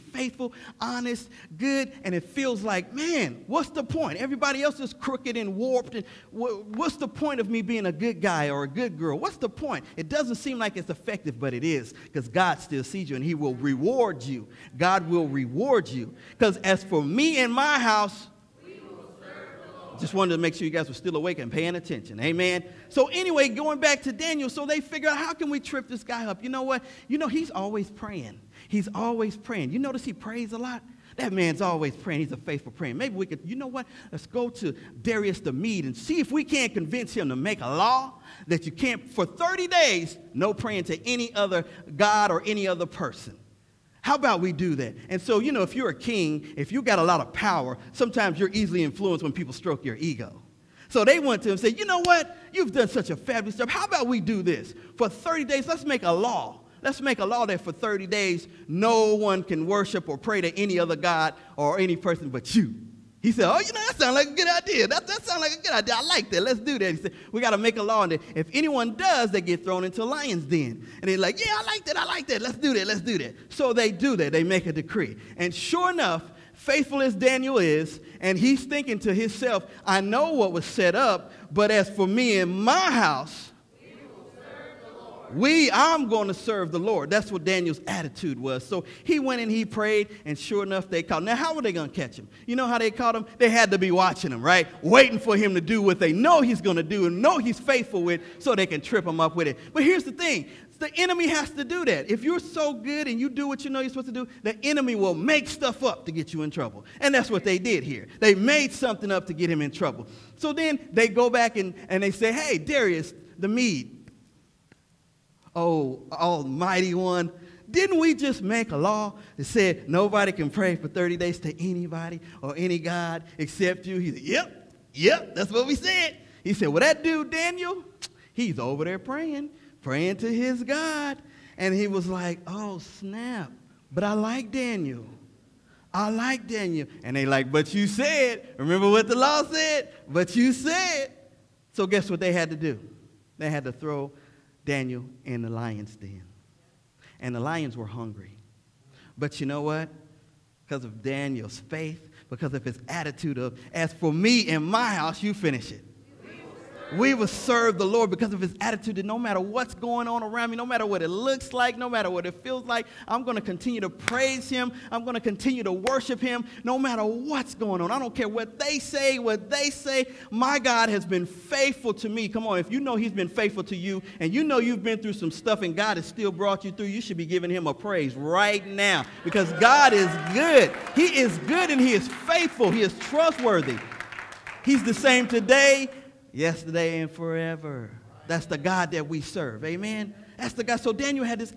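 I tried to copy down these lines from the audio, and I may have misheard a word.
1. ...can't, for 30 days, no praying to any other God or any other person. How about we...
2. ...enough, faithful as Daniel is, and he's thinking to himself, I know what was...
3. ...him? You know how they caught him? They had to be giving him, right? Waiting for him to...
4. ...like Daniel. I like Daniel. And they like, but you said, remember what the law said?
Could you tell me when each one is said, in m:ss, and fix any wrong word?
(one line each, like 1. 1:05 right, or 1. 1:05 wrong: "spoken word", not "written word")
1. 0:38 right
2. 1:15 right
3. 1:32 wrong: "watching", not "giving"
4. 2:14 right.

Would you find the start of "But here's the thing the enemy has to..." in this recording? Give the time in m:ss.
1:39.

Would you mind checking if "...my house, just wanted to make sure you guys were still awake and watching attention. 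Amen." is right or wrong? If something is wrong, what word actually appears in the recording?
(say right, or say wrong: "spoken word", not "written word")
wrong: "paying", not "watching".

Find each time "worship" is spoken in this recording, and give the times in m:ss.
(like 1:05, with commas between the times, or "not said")
0:59, 2:45.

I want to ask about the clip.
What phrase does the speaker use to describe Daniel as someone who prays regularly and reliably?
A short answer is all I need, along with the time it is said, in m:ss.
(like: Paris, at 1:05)
A faithful prayer, at 0:32.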